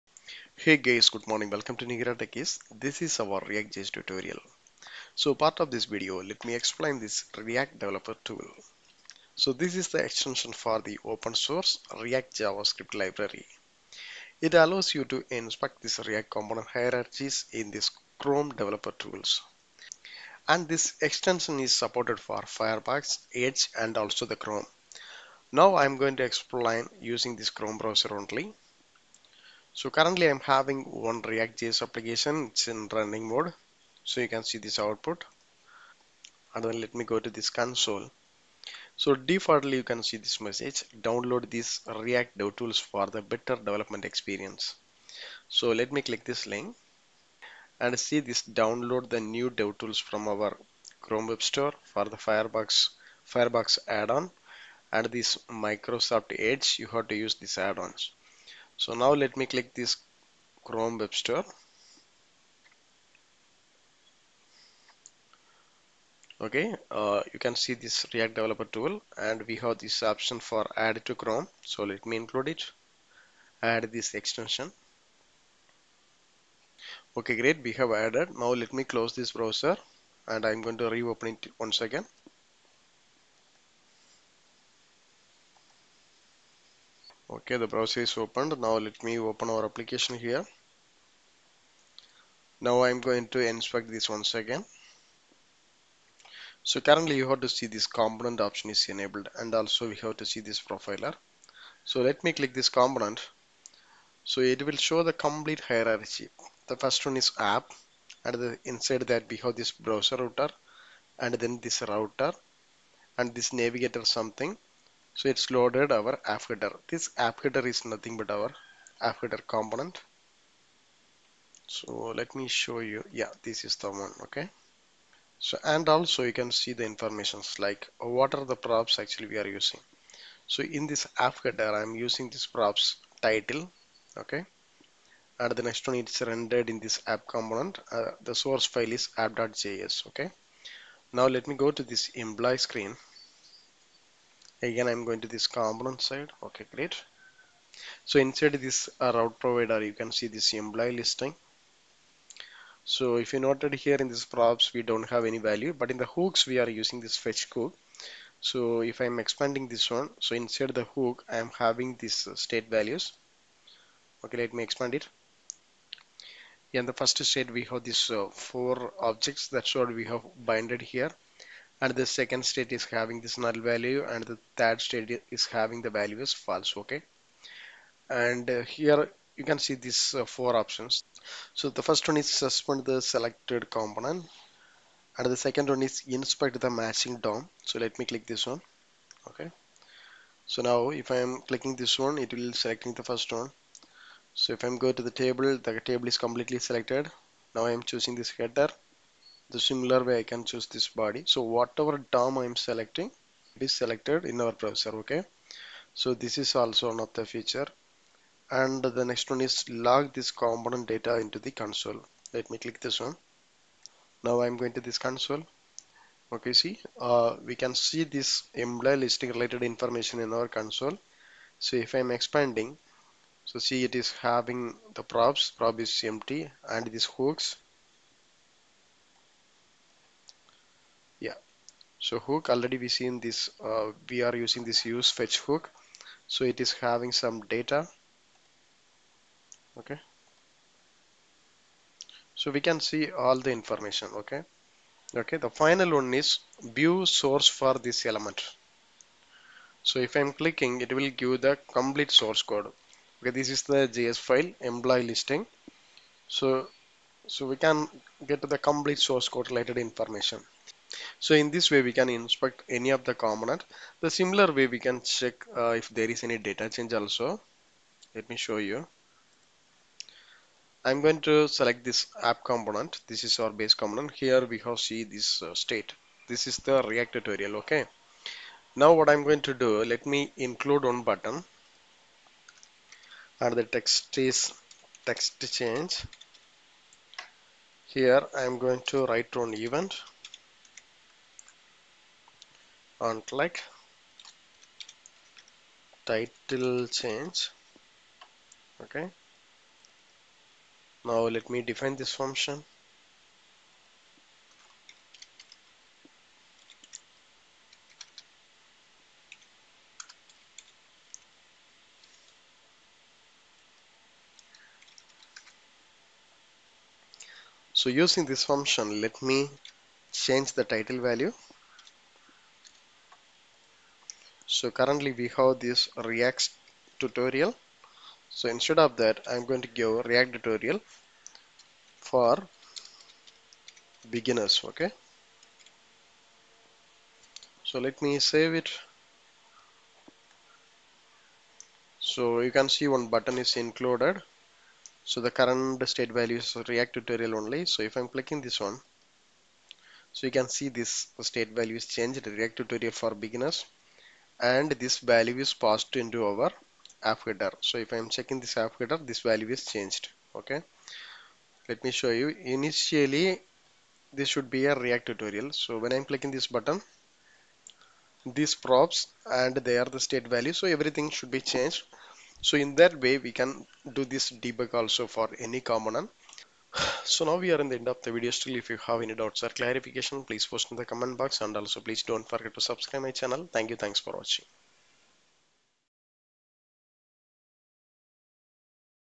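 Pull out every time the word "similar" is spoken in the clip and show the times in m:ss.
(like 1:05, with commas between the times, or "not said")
3:19, 4:24.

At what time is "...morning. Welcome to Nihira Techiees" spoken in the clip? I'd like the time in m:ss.
0:01.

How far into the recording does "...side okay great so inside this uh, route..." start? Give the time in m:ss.
2:26.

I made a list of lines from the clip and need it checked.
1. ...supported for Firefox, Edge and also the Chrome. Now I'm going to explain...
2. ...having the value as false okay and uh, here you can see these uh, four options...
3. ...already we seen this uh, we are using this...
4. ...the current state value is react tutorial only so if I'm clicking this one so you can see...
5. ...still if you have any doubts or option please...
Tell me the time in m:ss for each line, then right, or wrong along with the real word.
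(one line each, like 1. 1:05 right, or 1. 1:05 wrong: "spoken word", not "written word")
1. 0:21 right
2. 2:55 right
3. 3:52 right
4. 5:45 right
5. 6:18 wrong: "clarification", not "option".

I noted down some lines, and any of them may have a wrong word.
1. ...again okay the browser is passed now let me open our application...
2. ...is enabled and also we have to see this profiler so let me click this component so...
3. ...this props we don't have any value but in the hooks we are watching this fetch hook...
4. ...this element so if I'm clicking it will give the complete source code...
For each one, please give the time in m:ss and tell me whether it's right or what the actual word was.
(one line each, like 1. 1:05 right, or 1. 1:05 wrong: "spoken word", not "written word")
1. 1:21 wrong: "opened", not "passed"
2. 1:38 right
3. 2:34 wrong: "using", not "watching"
4. 4:07 right.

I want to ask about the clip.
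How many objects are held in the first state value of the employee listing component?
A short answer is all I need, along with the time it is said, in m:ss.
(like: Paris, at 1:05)
4, at 2:48.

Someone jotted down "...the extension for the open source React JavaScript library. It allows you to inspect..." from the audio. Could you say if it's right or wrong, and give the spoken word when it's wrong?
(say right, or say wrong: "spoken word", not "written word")
right.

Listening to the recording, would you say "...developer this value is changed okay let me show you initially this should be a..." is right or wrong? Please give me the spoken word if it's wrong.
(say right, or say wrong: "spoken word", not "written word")
wrong: "header", not "developer".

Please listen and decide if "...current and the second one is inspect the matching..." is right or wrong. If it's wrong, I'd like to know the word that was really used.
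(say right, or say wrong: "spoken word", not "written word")
wrong: "component", not "current".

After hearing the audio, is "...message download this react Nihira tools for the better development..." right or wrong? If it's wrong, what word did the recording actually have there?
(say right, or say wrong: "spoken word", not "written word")
wrong: "DevTools", not "Nihira".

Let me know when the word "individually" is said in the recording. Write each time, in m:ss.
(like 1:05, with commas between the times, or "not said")
not said.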